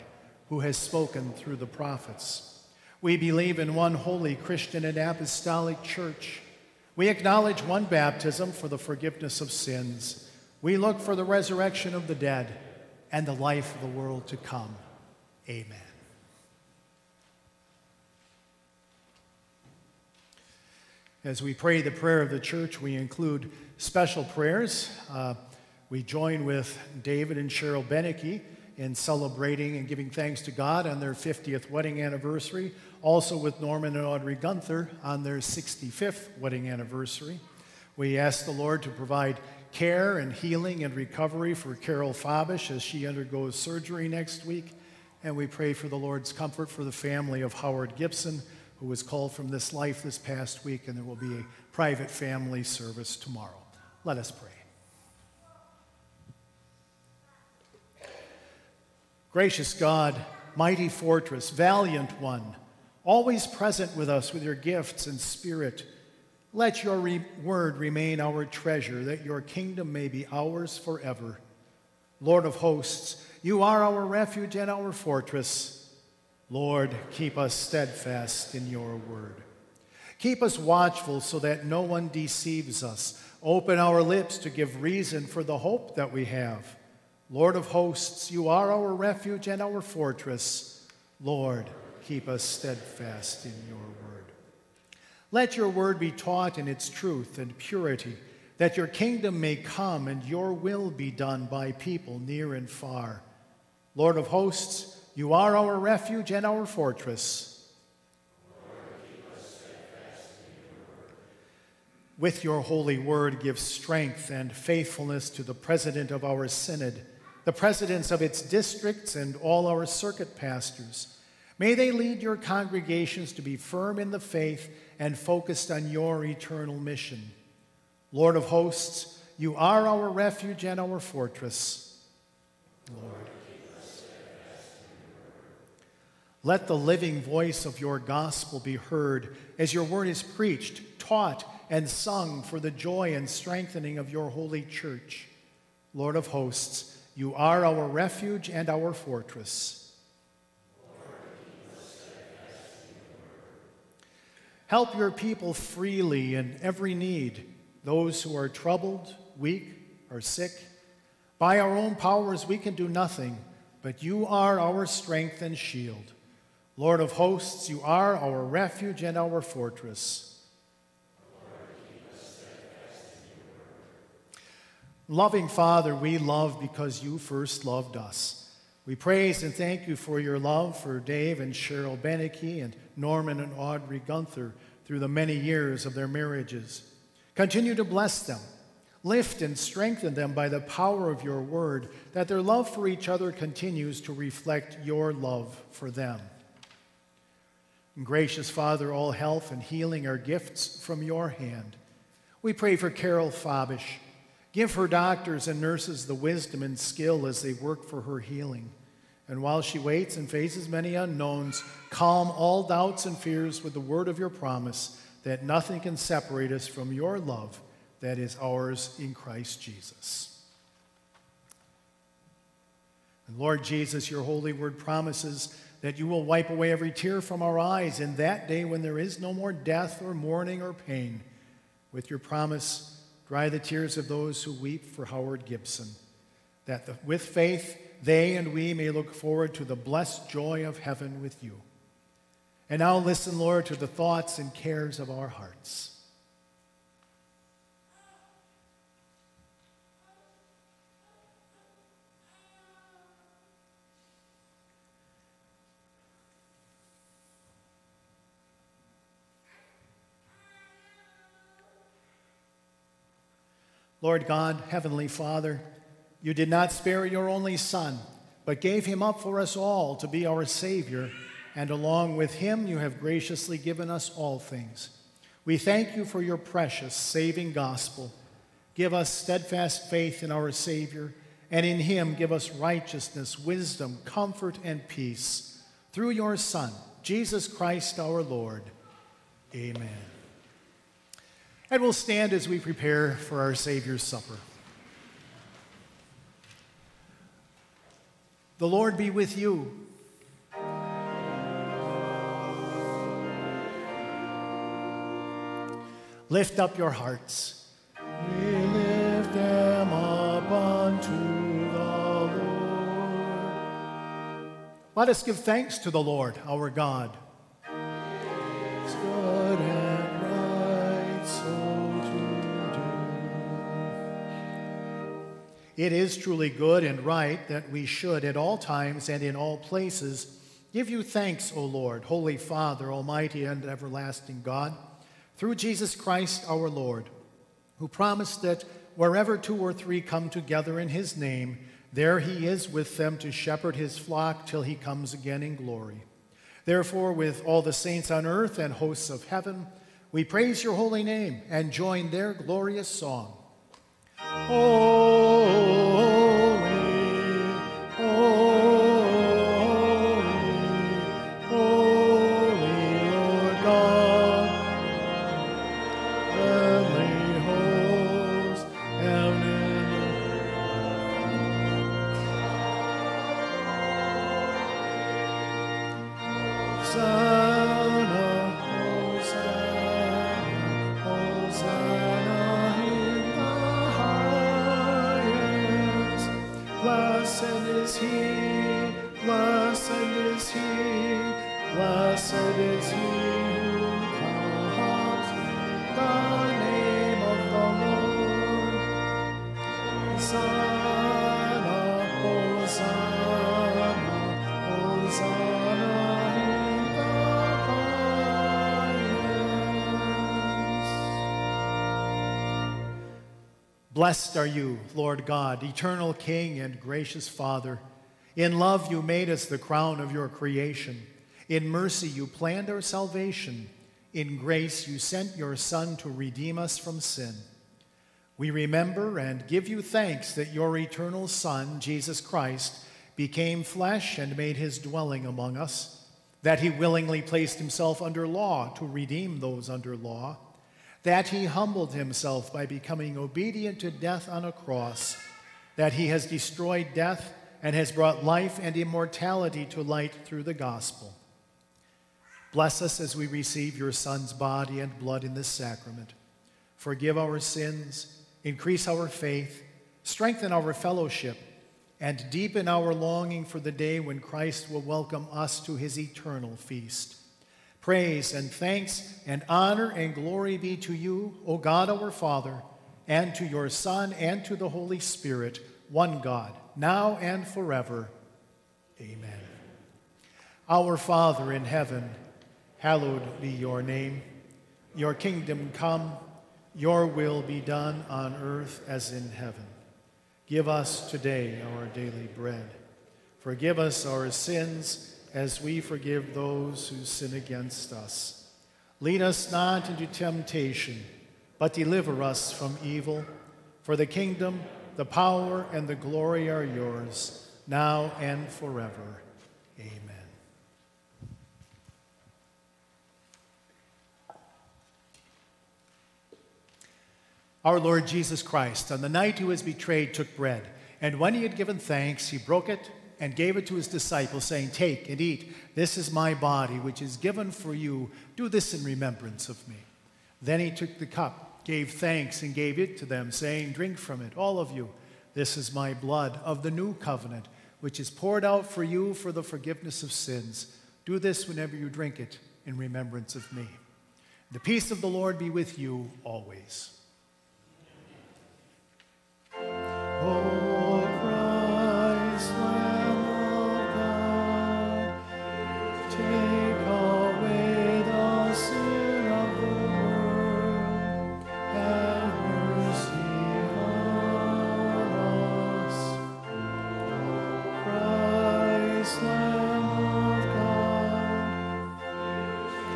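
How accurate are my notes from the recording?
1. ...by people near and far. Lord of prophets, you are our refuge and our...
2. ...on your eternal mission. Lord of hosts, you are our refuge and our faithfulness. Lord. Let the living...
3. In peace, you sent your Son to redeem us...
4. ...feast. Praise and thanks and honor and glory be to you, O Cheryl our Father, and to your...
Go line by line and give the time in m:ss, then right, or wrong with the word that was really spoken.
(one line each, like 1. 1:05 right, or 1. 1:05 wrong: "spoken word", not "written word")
1. 1:41 wrong: "hosts", not "prophets"
2. 2:05 wrong: "fortress", not "faithfulness"
3. 7:04 wrong: "grace", not "peace"
4. 7:46 wrong: "God", not "Cheryl".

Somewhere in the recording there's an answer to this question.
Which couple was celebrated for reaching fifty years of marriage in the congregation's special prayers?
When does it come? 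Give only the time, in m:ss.
0:27.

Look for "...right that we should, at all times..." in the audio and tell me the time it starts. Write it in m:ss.
5:27.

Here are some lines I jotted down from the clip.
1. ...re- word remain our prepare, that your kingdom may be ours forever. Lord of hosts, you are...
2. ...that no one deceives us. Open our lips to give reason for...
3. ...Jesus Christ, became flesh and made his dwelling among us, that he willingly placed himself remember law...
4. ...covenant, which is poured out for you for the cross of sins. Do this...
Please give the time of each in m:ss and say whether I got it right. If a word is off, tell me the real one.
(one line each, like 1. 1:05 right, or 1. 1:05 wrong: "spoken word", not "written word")
1. 1:06 wrong: "treasure", not "prepare"
2. 1:21 right
3. 7:11 wrong: "under", not "remember"
4. 8:56 wrong: "forgiveness", not "cross".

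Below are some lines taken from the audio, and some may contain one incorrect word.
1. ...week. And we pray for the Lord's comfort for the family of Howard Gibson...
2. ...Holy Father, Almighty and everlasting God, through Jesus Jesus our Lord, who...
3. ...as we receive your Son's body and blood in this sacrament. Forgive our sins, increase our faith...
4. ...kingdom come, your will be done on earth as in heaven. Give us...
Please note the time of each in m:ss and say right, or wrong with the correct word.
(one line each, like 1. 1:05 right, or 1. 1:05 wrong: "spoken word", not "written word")
1. 0:44 right
2. 5:32 wrong: "Christ", not "Jesus"
3. 7:32 right
4. 8:05 right.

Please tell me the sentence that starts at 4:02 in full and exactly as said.
And now listen, Lord, to the thoughts and cares of our hearts.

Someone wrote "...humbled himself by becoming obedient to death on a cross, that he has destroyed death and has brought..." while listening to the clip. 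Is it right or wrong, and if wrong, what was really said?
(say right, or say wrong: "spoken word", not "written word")
right.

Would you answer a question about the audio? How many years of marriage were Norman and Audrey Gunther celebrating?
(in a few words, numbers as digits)
65.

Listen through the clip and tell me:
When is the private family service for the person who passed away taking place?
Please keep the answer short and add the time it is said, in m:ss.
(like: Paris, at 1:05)
Tomorrow, at 0:53.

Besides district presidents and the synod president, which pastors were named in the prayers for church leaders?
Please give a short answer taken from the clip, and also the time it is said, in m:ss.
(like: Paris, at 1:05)
Circuit pastors, at 1:59.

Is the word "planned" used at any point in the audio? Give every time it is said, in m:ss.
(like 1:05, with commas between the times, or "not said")
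7:02.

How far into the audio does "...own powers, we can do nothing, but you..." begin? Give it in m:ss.
2:41.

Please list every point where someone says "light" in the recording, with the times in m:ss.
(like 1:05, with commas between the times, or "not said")
7:29.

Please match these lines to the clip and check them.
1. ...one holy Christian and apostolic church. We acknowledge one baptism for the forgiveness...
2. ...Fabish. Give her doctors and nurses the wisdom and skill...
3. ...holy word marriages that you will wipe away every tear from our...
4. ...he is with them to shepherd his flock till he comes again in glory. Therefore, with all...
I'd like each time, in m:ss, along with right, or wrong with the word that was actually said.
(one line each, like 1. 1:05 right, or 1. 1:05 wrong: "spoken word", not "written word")
1. 0:03 right
2. 3:23 right
3. 3:44 wrong: "promises", not "marriages"
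4. 5:42 right.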